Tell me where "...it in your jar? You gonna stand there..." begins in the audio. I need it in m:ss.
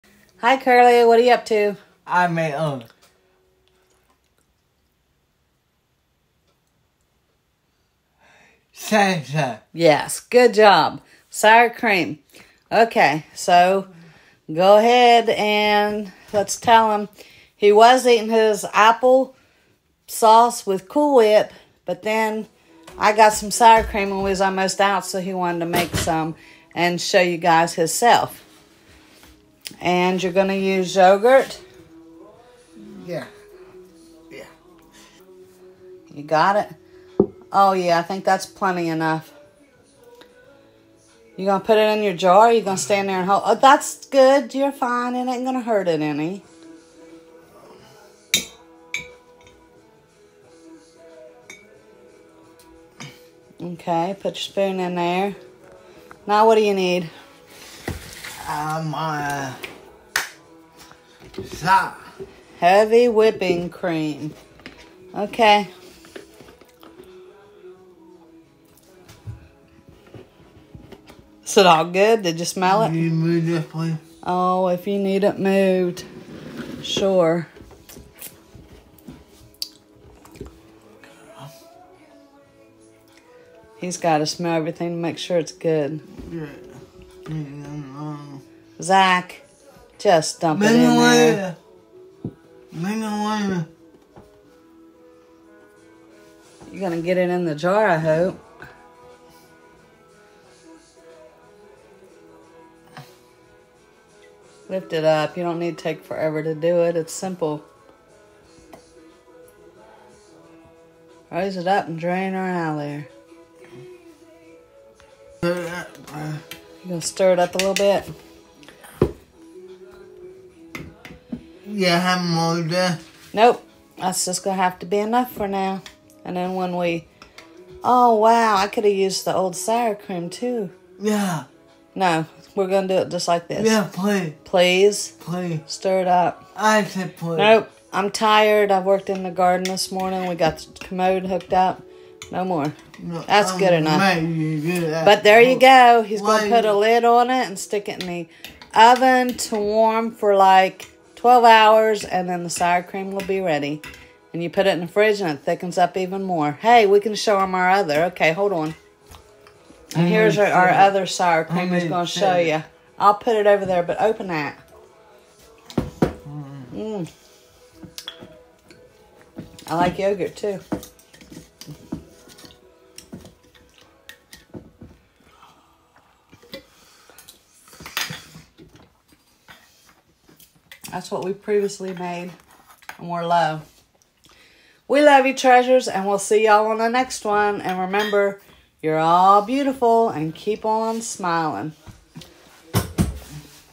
0:41.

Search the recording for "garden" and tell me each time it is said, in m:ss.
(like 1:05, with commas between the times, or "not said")
2:19.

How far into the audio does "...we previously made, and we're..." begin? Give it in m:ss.
3:01.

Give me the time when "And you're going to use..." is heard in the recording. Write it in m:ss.
0:29.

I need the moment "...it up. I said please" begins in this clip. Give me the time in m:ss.
2:16.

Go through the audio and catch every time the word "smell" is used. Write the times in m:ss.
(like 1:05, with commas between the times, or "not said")
1:12, 1:24.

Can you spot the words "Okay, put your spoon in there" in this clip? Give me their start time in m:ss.
0:53.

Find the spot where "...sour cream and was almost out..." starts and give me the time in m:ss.
0:23.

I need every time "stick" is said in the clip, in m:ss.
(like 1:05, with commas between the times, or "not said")
2:27.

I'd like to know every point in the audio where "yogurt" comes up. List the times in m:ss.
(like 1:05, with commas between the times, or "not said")
0:30, 2:49.